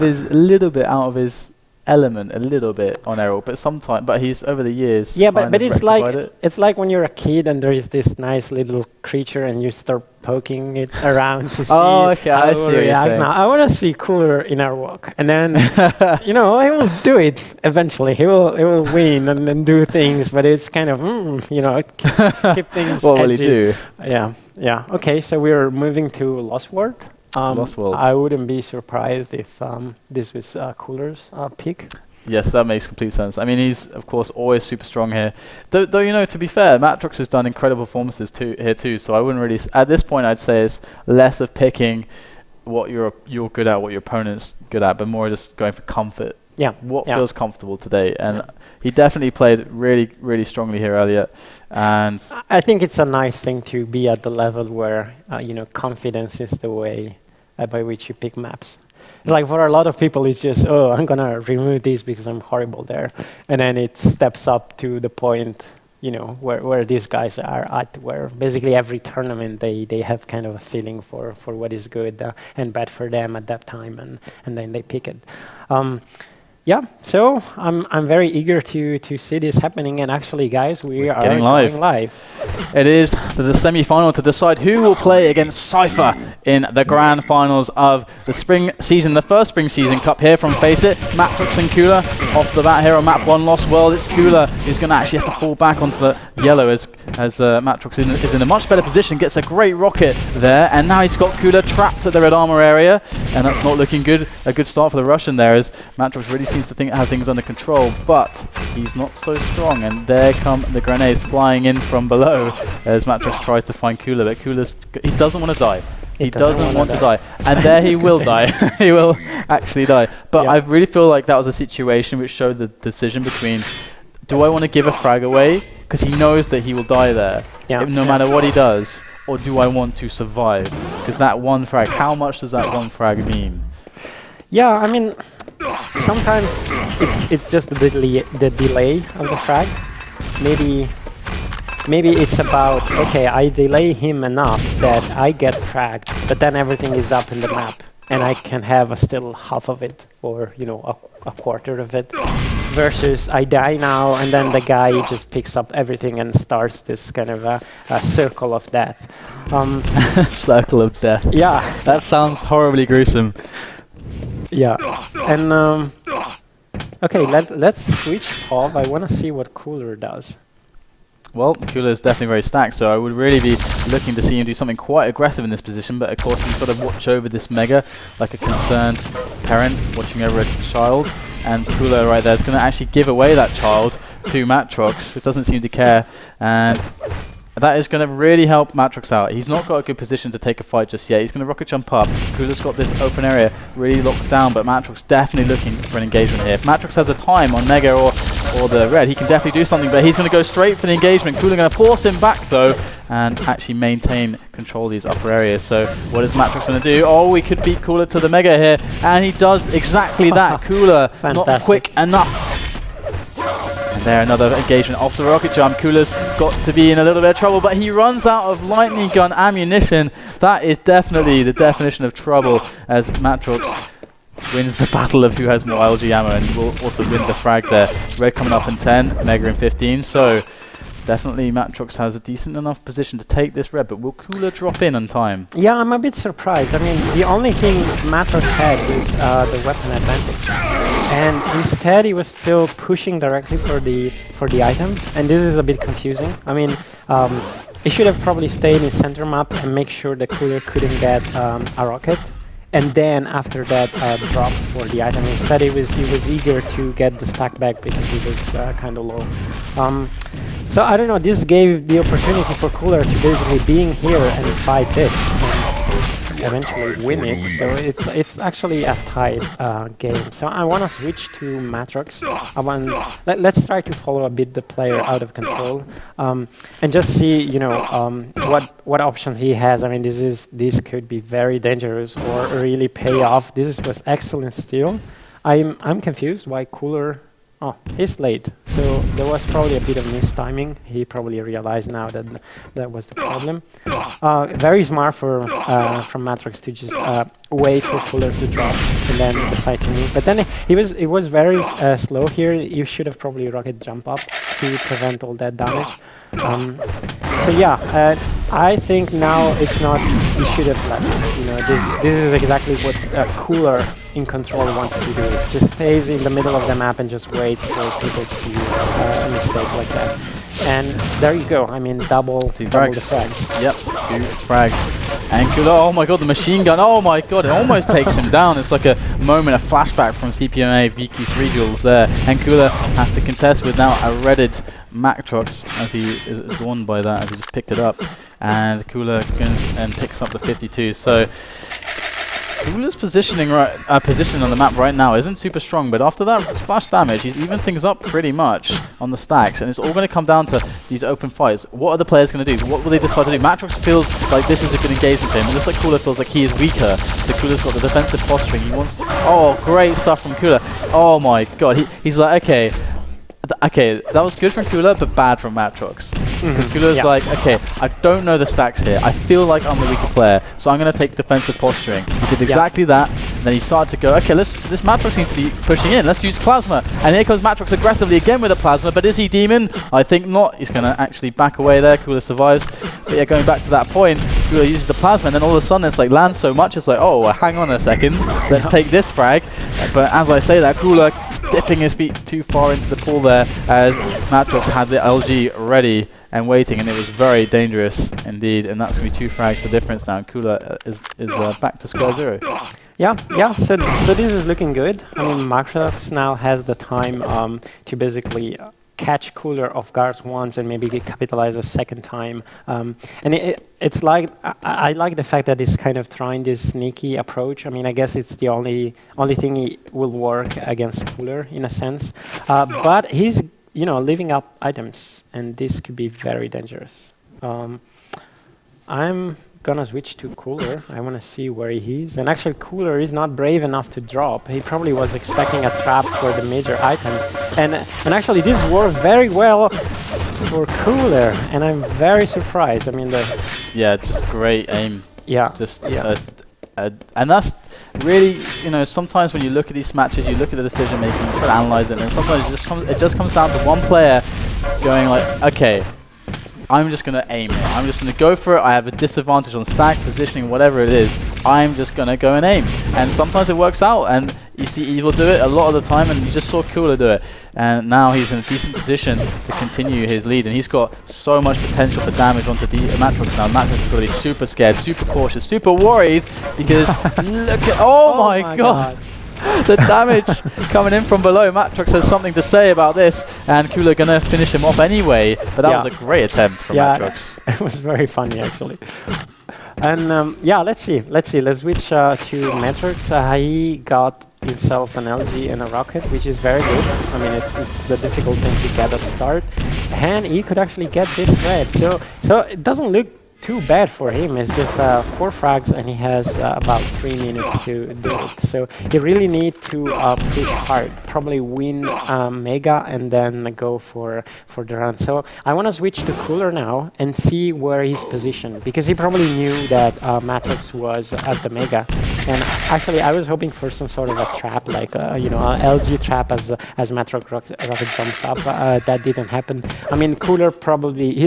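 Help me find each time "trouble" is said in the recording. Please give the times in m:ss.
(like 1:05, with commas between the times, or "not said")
3:37, 3:42.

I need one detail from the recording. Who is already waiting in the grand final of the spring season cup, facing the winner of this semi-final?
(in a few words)
Cypher.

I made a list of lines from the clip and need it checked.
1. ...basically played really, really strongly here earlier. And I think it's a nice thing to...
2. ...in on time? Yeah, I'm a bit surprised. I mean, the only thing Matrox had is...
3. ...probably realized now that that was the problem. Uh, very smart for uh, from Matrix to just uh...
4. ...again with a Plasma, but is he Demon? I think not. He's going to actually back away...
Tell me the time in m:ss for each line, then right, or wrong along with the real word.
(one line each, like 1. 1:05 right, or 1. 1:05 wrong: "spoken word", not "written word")
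1. 0:48 wrong: "definitely", not "basically"
2. 3:54 right
3. 4:51 right
4. 6:18 right.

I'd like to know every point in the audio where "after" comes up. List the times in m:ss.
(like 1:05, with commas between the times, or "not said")
4:13, 5:46.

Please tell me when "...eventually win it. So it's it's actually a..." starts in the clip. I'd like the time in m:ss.
4:26.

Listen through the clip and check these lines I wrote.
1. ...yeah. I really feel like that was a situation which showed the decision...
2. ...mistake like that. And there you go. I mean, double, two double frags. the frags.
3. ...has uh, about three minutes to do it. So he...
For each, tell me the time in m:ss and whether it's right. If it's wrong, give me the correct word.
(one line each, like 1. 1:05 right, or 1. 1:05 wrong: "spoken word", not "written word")
1. 2:00 right
2. 5:19 right
3. 8:25 right.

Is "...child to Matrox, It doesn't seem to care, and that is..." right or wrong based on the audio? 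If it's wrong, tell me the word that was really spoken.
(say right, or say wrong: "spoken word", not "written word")
right.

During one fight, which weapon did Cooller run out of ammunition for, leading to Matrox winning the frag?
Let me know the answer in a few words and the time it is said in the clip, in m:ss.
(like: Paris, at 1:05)
lightning gun, at 3:38.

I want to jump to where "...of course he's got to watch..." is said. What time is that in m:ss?
2:56.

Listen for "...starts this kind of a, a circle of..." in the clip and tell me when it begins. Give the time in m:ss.
2:36.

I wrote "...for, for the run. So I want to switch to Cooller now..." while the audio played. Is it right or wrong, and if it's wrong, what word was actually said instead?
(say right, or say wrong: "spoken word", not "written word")
right.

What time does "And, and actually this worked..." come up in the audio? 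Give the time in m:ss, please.
7:17.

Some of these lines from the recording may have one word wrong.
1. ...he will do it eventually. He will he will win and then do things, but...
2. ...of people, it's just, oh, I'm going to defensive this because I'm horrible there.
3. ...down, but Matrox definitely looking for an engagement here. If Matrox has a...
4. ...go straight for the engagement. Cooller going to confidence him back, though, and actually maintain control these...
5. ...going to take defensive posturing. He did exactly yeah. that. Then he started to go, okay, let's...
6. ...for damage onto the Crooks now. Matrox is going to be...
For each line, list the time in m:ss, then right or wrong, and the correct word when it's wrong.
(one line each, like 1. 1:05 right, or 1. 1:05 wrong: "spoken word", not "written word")
1. 0:16 right
2. 0:59 wrong: "remove", not "defensive"
3. 3:14 right
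4. 3:20 wrong: "force", not "confidence"
5. 6:10 right
6. 7:52 wrong: "Matrox", not "Crooks".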